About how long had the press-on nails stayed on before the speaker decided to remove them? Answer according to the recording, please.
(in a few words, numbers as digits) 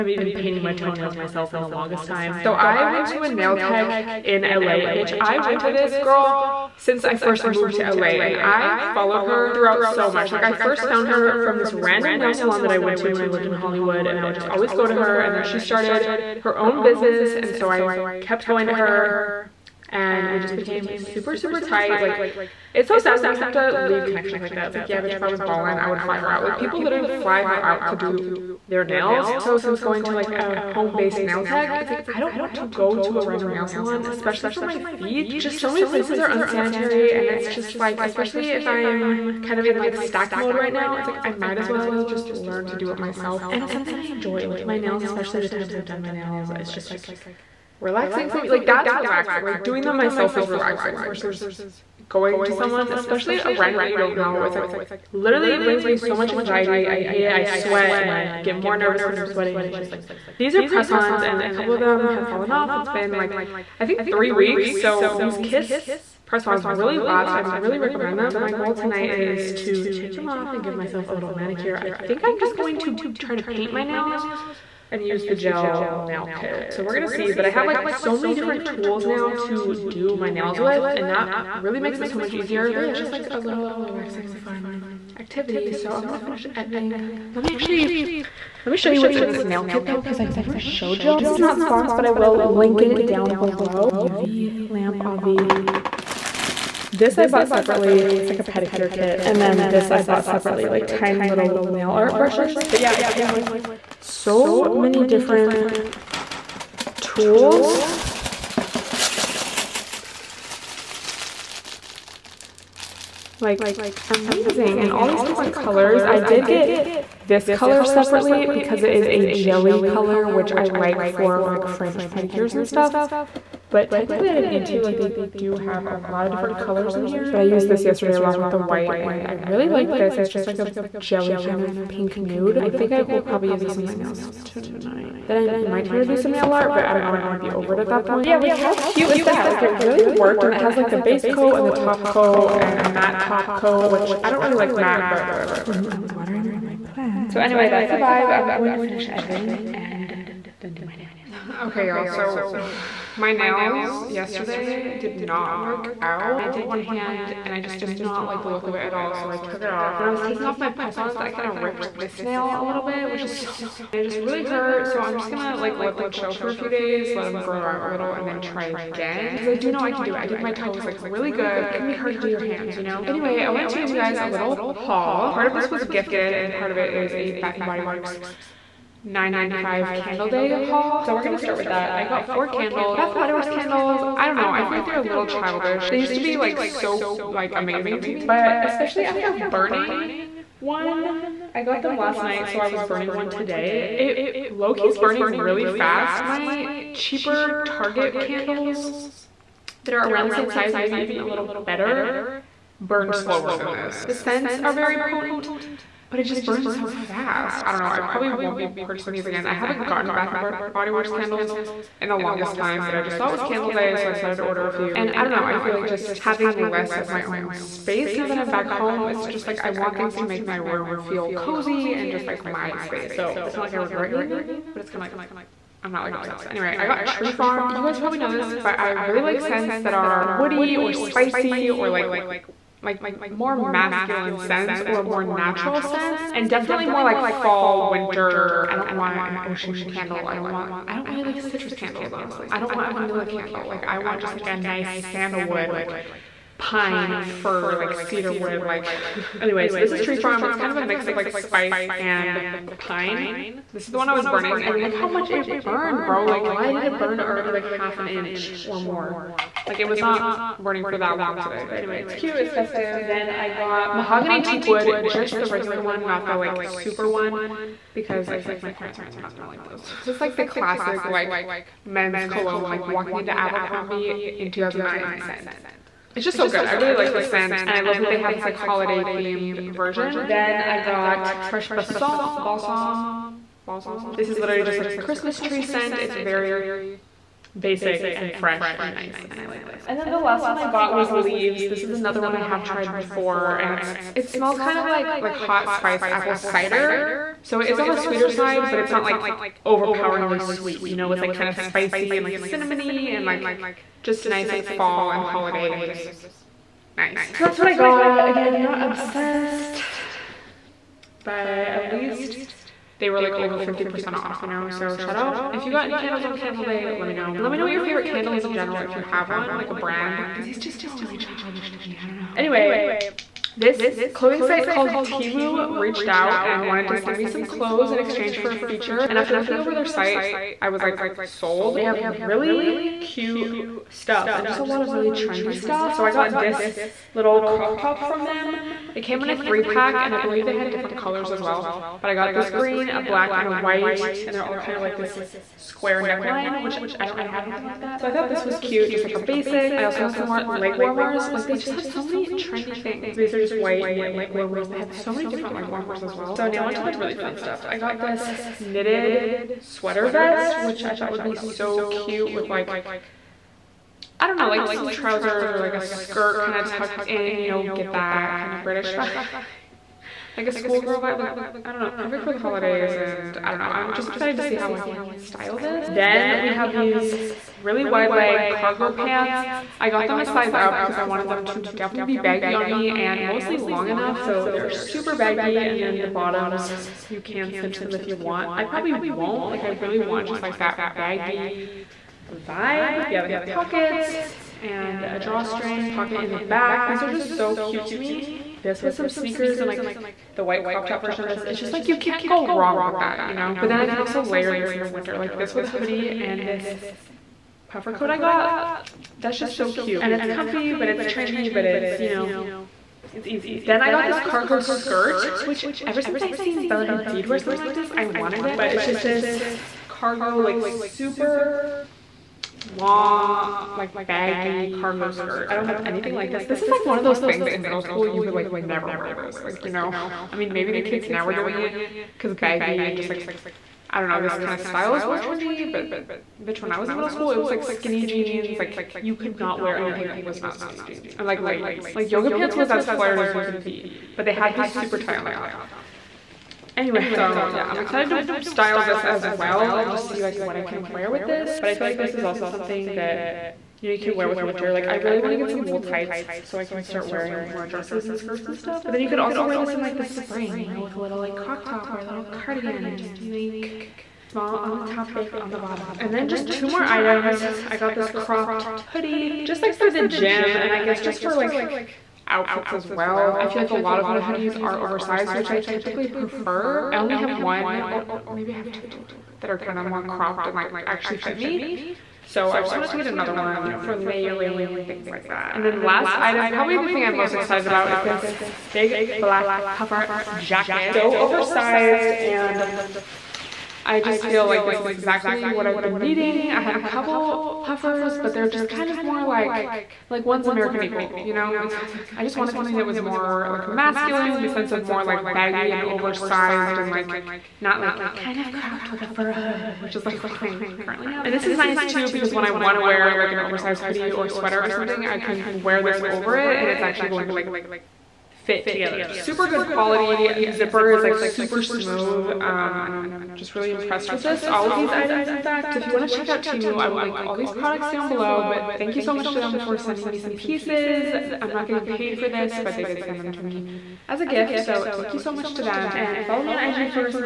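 3 weeks.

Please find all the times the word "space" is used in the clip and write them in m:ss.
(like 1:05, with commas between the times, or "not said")
3:37, 3:42.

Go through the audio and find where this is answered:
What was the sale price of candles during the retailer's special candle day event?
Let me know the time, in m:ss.
2:59.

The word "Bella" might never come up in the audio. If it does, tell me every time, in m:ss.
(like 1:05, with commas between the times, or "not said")
6:56.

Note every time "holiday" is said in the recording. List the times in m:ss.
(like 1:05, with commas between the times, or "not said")
4:38, 5:05, 6:12.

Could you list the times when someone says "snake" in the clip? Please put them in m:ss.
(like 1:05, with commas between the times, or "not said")
not said.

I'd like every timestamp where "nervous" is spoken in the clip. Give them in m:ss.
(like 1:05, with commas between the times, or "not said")
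0:58.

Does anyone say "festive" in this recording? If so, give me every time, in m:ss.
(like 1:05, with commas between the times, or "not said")
4:22.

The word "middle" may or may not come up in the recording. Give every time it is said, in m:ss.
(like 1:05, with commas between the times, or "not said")
7:07, 7:16.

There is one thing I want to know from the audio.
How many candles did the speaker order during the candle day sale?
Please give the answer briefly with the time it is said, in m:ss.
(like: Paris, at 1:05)
4, at 3:02.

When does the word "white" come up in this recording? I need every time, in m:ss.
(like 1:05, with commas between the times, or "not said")
2:08, 5:43, 5:53, 6:40.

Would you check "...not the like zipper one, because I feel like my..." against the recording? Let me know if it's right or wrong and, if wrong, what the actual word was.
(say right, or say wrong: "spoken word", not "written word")
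wrong: "super", not "zipper".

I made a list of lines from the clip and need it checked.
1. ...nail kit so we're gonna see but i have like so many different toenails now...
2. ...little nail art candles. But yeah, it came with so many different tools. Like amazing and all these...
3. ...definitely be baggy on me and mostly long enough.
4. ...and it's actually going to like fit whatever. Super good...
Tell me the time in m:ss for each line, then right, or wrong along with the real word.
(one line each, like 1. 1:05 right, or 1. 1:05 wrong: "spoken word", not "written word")
1. 1:15 wrong: "tools", not "toenails"
2. 1:41 wrong: "brushes", not "candles"
3. 6:21 right
4. 8:36 wrong: "together", not "whatever".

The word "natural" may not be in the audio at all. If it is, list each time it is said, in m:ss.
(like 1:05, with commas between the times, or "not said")
3:55.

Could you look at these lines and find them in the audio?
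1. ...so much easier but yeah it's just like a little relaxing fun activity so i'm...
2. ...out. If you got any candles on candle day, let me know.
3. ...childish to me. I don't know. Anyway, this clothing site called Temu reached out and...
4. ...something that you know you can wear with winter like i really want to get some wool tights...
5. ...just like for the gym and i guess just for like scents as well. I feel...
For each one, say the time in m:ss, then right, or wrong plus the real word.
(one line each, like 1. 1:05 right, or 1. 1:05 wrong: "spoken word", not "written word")
1. 1:22 right
2. 5:15 right
3. 5:21 right
4. 7:32 right
5. 7:49 wrong: "outfits", not "scents".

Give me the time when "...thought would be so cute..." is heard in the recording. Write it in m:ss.
6:00.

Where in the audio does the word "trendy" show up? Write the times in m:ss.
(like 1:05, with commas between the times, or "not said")
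5:35, 5:52, 6:51, 7:15.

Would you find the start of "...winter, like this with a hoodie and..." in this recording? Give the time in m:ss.
6:44.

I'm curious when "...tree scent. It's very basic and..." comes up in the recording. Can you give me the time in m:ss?
4:45.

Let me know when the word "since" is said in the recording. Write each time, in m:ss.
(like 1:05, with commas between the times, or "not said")
0:06, 0:29, 6:56.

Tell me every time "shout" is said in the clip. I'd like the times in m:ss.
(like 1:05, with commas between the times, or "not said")
5:14.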